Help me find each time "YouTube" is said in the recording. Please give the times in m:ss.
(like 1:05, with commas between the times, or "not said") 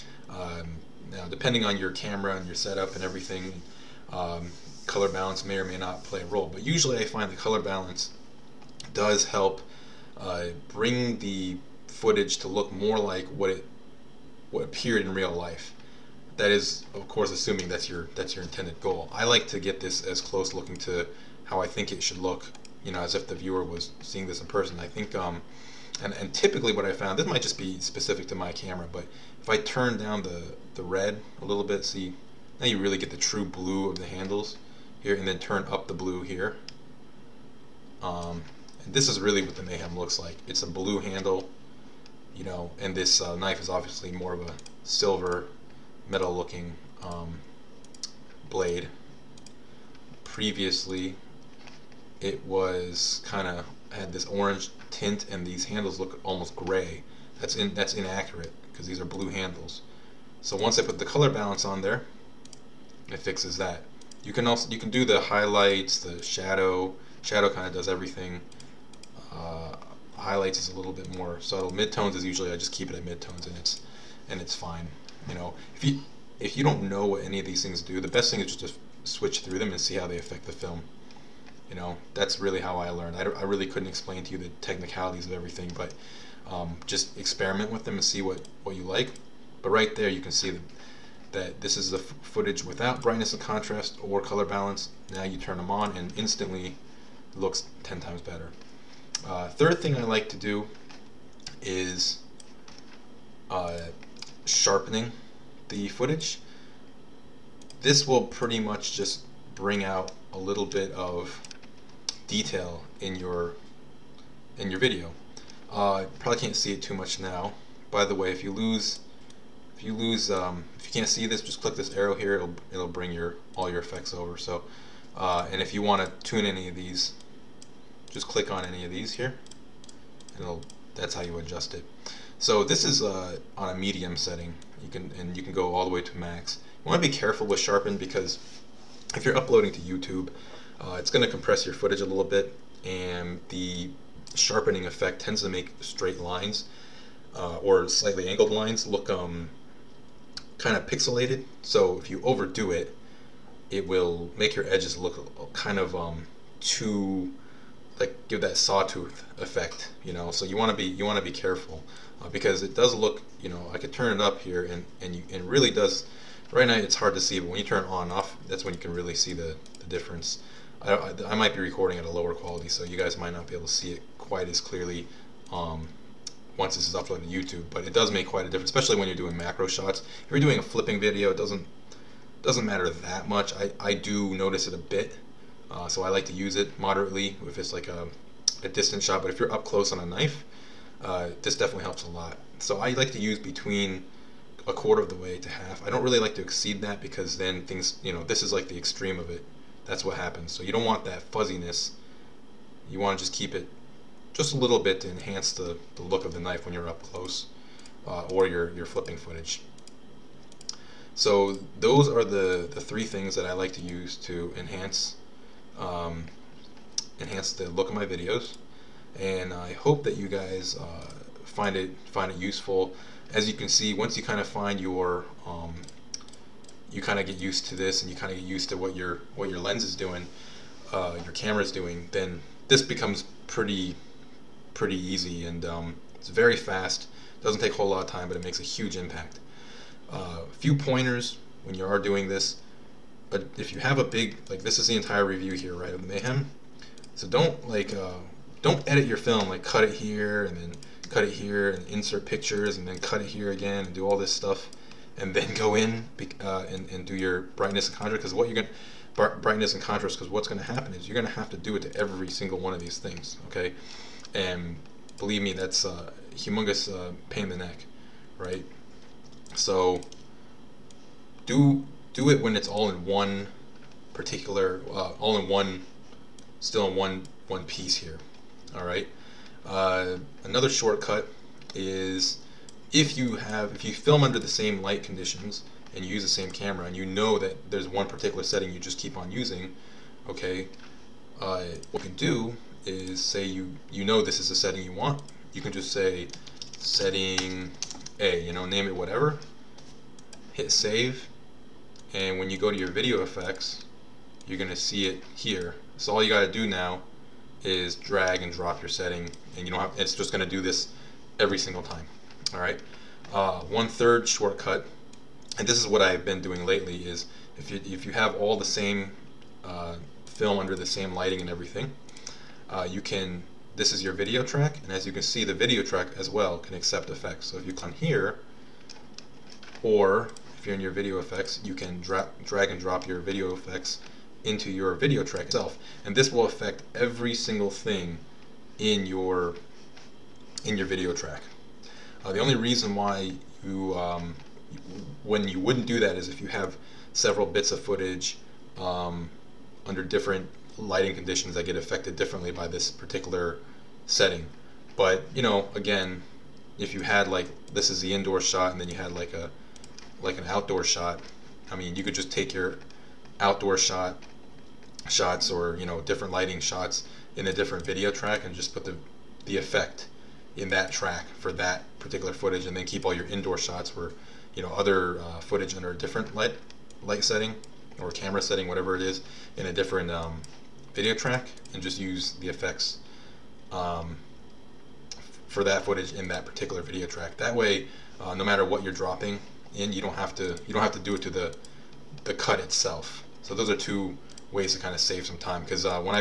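2:19, 2:57.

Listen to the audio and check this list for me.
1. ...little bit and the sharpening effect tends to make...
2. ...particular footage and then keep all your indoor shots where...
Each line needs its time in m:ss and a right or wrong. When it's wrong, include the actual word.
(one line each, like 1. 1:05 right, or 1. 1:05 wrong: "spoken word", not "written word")
1. 2:22 right
2. 6:11 right.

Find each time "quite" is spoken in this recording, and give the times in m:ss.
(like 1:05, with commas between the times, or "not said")
2:54, 2:58.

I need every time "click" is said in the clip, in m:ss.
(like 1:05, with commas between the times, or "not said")
2:01, 2:08.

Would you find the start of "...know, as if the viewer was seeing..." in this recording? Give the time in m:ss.
0:22.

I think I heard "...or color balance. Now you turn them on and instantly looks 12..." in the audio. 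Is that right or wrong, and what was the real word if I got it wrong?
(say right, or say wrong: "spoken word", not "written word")
wrong: "10", not "12".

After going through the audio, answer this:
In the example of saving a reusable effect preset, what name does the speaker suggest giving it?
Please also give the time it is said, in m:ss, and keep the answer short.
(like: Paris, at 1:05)
setting A, at 4:56.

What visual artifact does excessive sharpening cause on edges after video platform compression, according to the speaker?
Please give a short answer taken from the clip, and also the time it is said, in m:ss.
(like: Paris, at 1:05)
sawtooth effect, at 2:38.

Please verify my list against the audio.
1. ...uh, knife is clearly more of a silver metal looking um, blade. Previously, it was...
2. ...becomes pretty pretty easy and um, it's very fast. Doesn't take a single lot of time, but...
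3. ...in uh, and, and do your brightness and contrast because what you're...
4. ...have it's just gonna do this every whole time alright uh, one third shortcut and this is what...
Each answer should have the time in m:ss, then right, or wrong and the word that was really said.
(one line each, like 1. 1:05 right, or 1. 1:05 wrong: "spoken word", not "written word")
1. 0:43 wrong: "obviously", not "clearly"
2. 3:52 wrong: "whole", not "single"
3. 4:15 right
4. 5:09 wrong: "single", not "whole".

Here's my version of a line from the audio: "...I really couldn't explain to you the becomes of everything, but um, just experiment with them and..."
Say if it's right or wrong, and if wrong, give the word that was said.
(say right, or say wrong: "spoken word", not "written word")
wrong: "technicalities", not "becomes".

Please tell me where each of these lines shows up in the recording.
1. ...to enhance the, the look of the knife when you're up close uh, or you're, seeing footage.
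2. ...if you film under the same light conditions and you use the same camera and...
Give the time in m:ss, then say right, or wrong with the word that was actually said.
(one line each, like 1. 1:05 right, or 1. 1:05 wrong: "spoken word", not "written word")
1. 3:25 wrong: "flipping", not "seeing"
2. 4:43 right.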